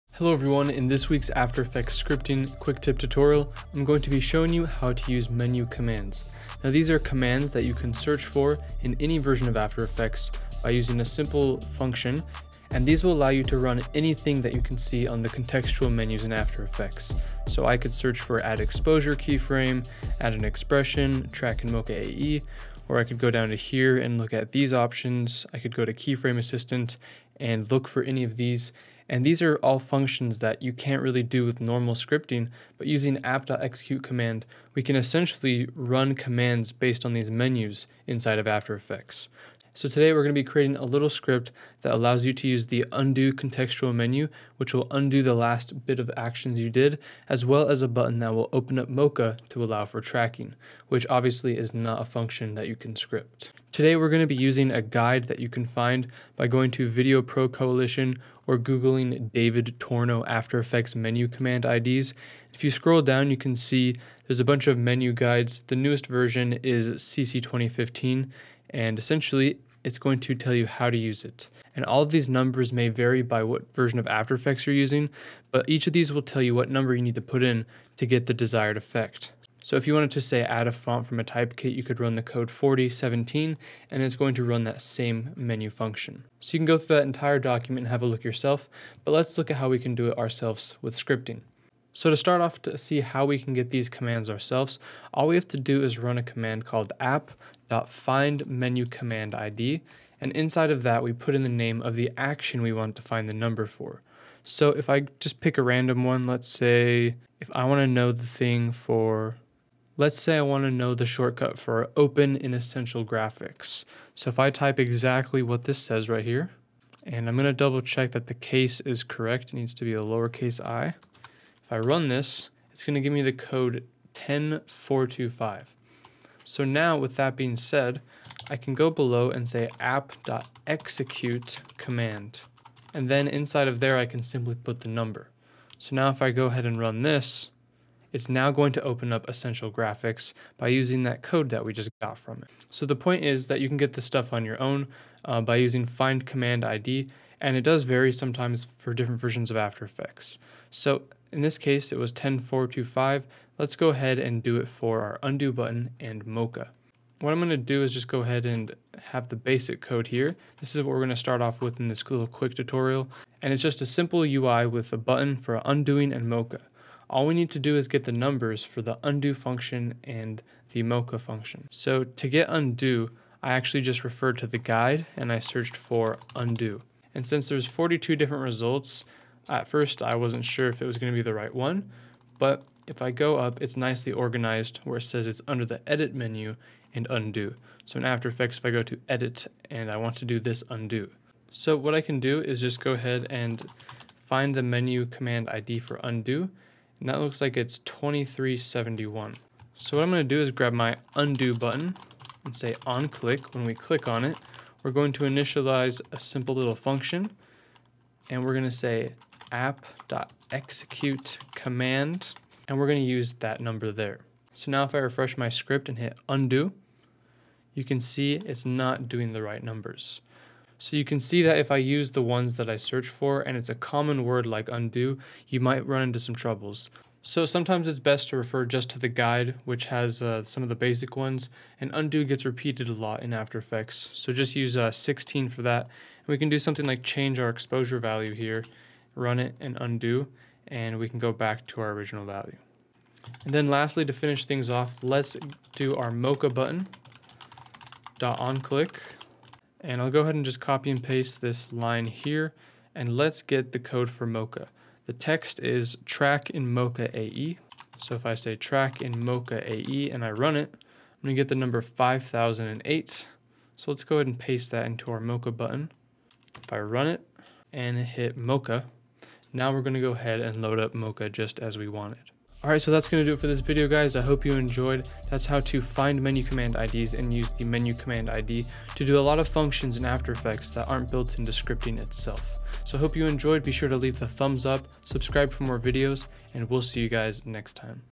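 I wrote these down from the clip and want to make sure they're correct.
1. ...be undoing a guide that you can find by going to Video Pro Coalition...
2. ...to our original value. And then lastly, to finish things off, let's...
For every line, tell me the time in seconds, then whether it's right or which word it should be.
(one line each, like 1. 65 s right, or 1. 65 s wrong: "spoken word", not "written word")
1. 54 s wrong: "using", not "undoing"
2. 241 s right.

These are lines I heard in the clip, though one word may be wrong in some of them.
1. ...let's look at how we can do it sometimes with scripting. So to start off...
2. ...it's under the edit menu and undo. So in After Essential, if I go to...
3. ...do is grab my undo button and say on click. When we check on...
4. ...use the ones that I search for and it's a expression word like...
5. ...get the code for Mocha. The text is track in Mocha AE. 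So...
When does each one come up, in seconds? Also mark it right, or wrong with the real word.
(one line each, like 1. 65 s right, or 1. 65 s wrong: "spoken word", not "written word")
1. 89 s wrong: "ourselves", not "sometimes"
2. 185 s wrong: "Effects", not "Essential"
3. 200 s wrong: "click", not "check"
4. 221 s wrong: "common", not "expression"
5. 253 s right.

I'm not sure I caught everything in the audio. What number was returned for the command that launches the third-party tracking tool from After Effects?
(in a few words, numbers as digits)
5008.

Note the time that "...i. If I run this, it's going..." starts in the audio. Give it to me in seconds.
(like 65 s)
120 s.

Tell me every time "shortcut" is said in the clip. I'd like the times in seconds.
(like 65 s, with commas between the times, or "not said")
111 s.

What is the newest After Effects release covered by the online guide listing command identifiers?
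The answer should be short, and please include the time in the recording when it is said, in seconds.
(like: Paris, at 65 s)
CC 2015, at 66 s.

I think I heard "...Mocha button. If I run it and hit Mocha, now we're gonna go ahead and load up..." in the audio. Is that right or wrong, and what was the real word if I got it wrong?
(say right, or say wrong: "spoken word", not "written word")
right.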